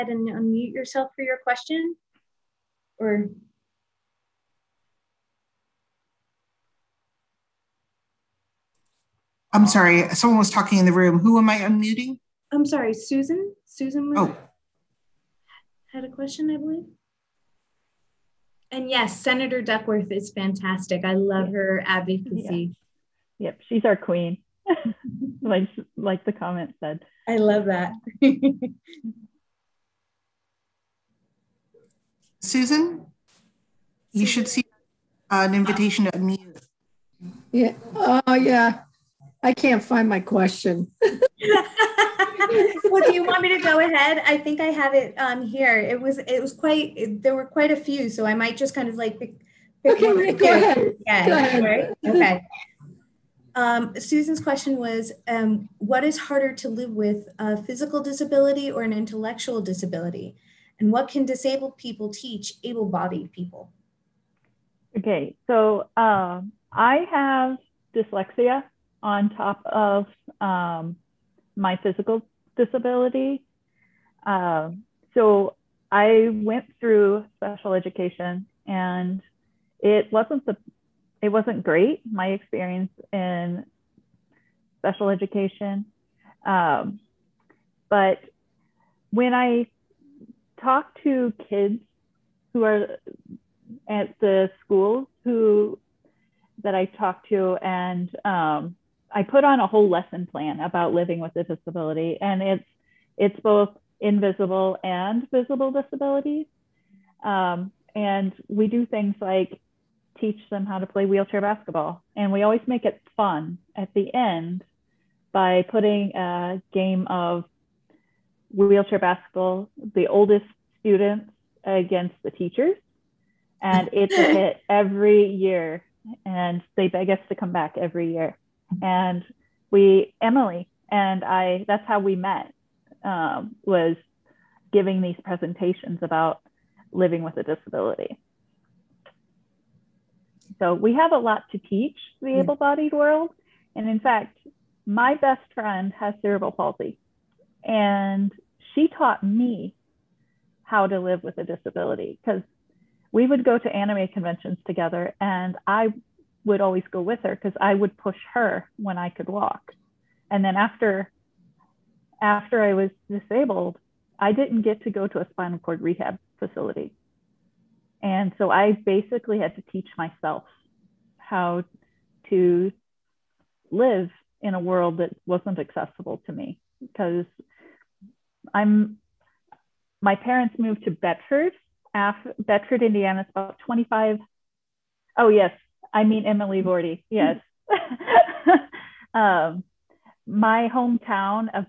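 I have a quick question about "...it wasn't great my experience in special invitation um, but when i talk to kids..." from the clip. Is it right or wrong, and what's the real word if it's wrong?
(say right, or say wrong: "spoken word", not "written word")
wrong: "education", not "invitation".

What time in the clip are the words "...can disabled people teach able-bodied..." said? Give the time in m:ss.
1:01.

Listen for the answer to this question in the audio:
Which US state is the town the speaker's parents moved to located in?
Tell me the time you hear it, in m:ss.
3:02.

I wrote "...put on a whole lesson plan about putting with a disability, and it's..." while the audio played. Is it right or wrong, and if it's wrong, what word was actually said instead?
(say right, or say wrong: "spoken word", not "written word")
wrong: "living", not "putting".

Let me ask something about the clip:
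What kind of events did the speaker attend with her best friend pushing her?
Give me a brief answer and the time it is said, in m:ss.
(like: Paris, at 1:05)
Anime conventions, at 2:33.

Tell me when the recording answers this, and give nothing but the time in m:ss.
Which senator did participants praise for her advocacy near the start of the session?
0:19.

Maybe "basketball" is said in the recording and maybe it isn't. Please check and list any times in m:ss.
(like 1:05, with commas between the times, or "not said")
1:51, 1:58.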